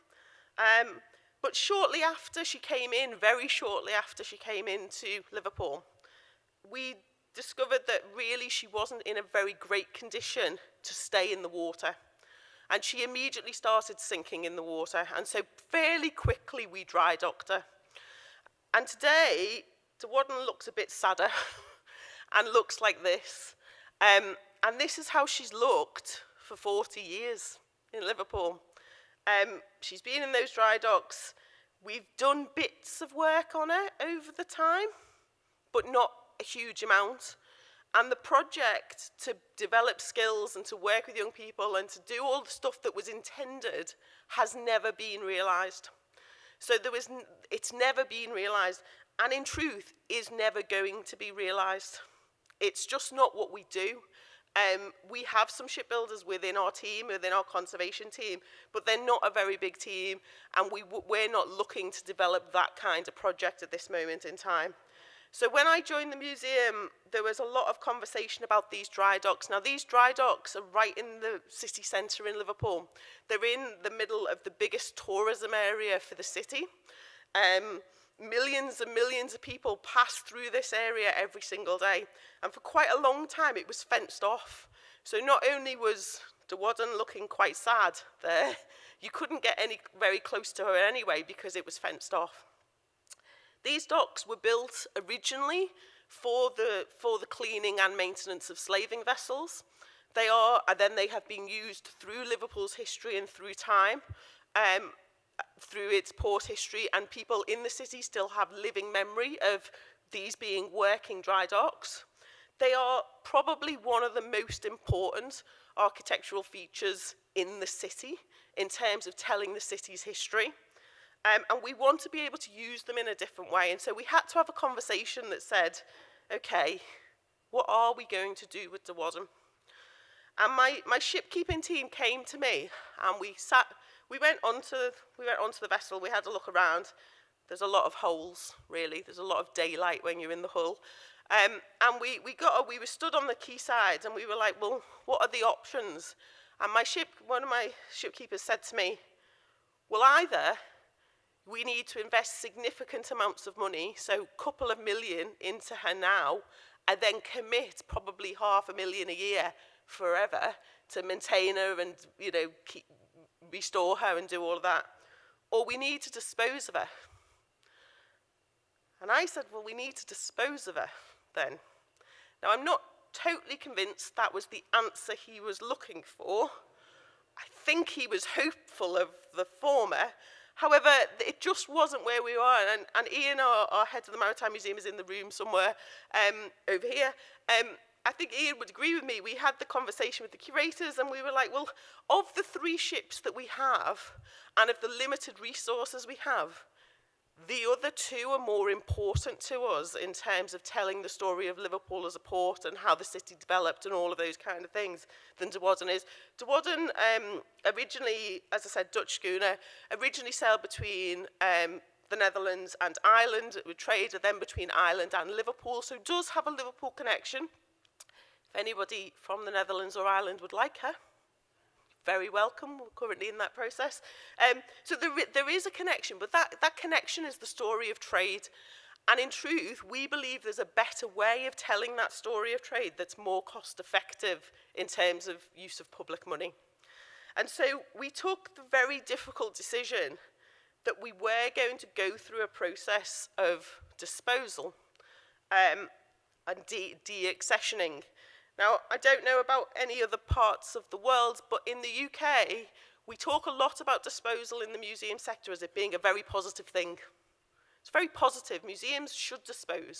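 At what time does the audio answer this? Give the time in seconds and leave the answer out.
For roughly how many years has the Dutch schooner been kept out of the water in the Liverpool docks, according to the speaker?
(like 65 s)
26 s.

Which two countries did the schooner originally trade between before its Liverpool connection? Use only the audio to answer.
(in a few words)
Netherlands and Ireland.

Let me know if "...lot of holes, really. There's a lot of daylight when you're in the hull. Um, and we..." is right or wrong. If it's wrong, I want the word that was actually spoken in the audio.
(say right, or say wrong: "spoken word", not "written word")
right.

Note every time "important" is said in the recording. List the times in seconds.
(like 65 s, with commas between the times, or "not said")
114 s, 198 s.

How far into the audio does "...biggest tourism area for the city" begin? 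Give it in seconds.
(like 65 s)
74 s.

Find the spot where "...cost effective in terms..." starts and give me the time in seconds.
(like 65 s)
233 s.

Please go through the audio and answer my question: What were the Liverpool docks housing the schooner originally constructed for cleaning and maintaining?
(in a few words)
Slaving vessels.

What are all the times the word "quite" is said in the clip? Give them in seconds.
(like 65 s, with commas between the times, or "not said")
82 s, 87 s.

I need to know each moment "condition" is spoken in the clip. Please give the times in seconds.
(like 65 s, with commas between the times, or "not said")
9 s.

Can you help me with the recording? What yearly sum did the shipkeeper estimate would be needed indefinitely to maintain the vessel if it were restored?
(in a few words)
Half a million.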